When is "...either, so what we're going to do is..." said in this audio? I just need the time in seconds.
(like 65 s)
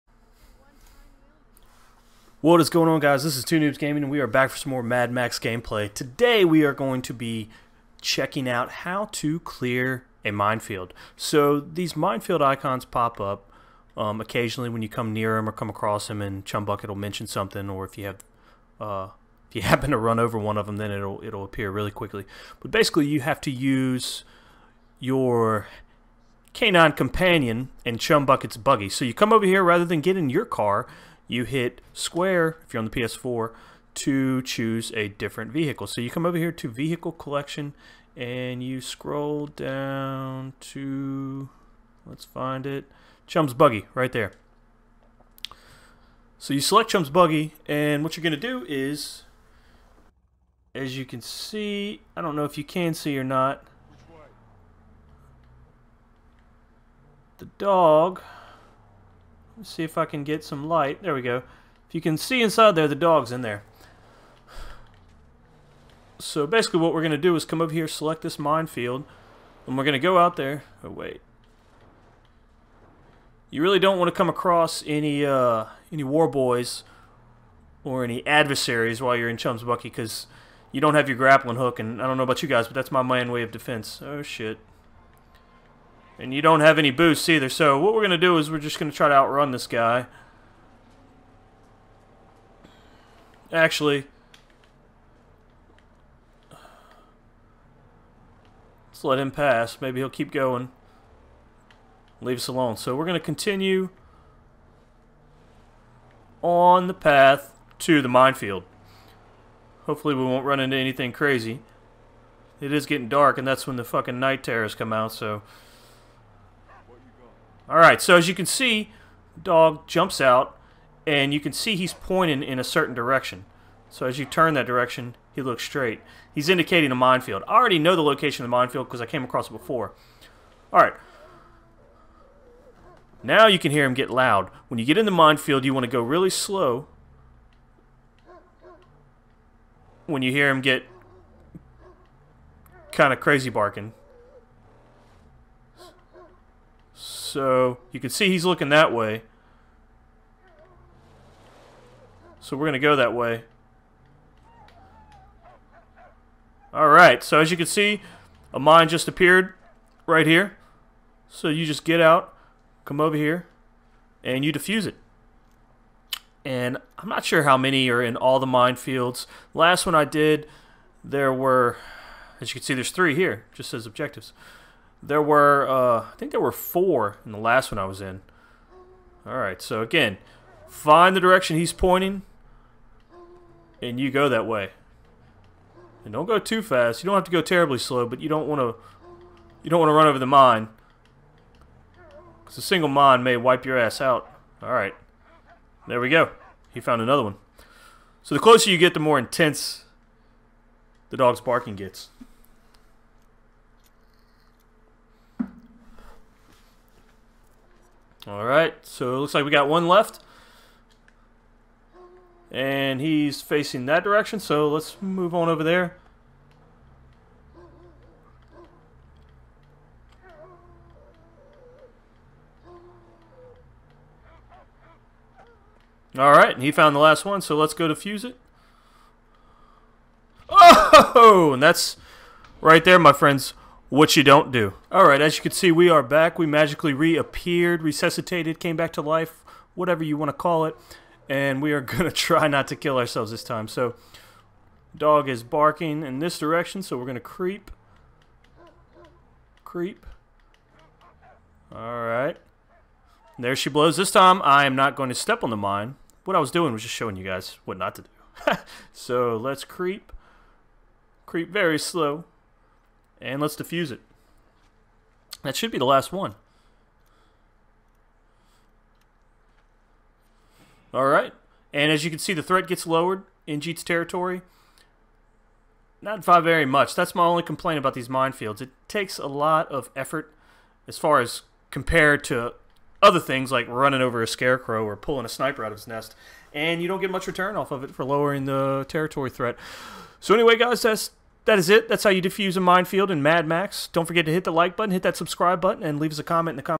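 87 s.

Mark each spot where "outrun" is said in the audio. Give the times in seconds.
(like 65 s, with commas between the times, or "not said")
89 s.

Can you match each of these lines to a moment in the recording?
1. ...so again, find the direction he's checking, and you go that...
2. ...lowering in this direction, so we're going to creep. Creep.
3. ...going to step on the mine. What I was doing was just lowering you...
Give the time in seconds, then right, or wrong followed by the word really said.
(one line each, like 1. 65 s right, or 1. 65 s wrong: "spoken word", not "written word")
1. 179 s wrong: "pointing", not "checking"
2. 245 s wrong: "barking", not "lowering"
3. 254 s wrong: "showing", not "lowering".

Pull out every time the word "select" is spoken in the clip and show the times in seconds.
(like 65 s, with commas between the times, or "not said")
46 s, 67 s.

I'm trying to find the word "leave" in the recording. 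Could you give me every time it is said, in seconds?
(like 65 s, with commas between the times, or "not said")
102 s, 295 s.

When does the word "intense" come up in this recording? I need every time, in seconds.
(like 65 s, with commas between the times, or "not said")
199 s.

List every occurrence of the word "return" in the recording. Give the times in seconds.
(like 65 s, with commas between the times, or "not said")
287 s.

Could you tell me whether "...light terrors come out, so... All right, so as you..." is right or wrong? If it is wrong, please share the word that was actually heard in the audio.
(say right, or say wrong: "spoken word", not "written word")
wrong: "night", not "light".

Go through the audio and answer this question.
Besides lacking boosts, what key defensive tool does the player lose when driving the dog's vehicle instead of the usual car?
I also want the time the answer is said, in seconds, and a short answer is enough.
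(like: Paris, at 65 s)
grappling hook, at 81 s.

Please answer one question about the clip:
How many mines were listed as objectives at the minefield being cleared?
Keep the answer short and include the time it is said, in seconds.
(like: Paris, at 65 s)
3, at 172 s.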